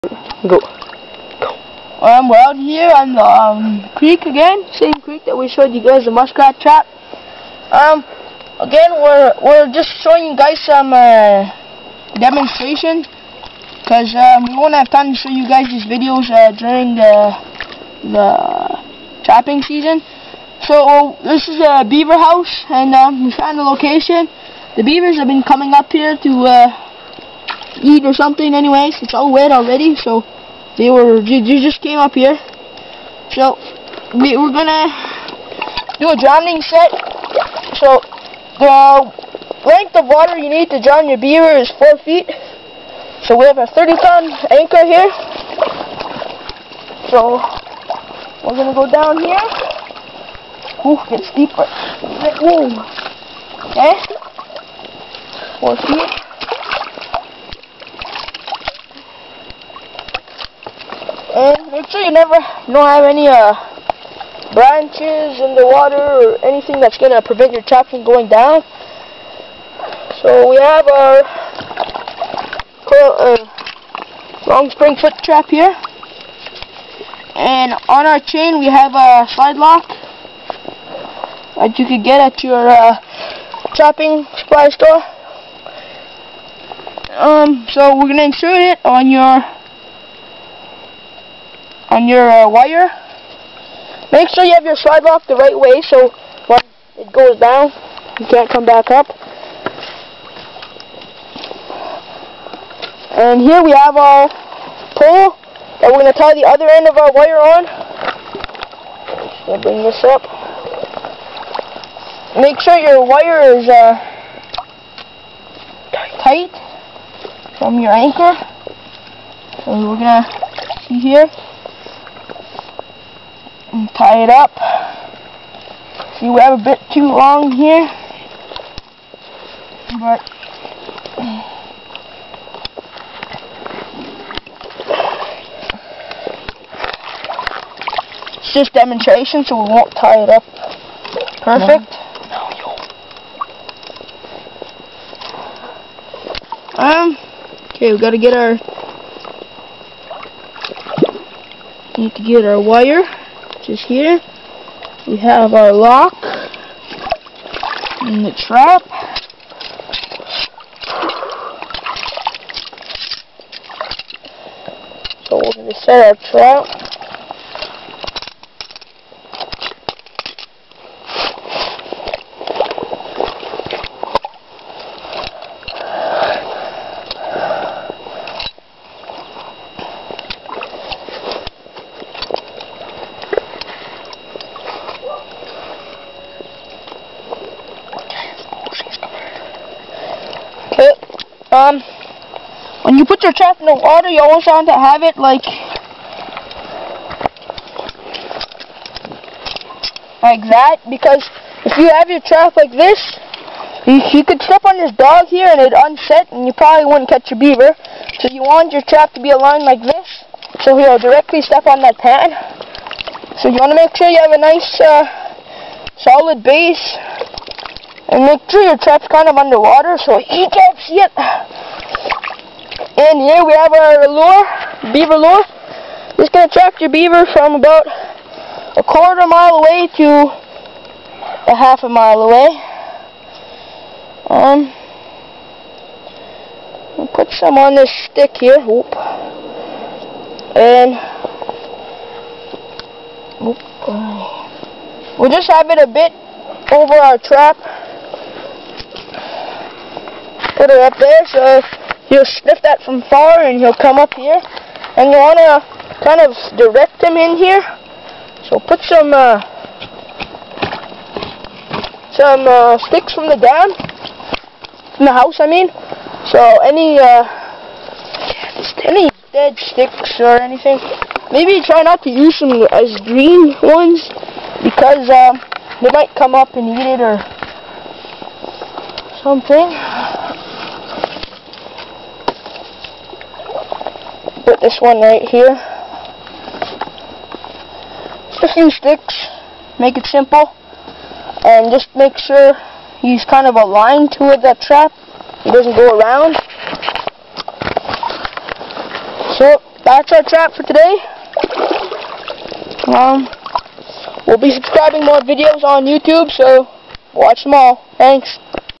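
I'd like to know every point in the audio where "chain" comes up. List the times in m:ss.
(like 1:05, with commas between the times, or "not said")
1:18.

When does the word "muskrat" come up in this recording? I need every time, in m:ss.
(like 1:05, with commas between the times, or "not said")
0:06.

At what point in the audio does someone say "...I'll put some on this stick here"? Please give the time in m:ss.
3:56.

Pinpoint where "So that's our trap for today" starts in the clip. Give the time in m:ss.
4:59.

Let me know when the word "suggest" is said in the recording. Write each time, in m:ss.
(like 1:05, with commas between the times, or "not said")
not said.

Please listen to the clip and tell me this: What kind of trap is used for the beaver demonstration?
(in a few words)
Long spring foot trap.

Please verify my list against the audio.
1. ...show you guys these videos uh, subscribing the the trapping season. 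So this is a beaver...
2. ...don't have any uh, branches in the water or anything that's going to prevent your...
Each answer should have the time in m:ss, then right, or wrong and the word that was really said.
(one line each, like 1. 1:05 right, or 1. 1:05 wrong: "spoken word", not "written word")
1. 0:15 wrong: "during", not "subscribing"
2. 1:02 right.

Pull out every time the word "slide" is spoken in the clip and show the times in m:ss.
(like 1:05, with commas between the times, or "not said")
1:19, 1:34.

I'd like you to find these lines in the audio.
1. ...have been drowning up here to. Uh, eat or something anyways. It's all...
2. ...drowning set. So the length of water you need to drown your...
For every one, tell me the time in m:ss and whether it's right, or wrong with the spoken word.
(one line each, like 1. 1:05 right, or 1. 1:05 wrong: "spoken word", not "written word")
1. 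0:25 wrong: "coming", not "drowning"
2. 0:36 right.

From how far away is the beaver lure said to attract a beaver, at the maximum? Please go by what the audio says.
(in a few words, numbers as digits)
Half a mile.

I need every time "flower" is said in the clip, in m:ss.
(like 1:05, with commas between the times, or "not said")
not said.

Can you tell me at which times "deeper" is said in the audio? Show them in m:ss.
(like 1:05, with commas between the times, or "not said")
0:51.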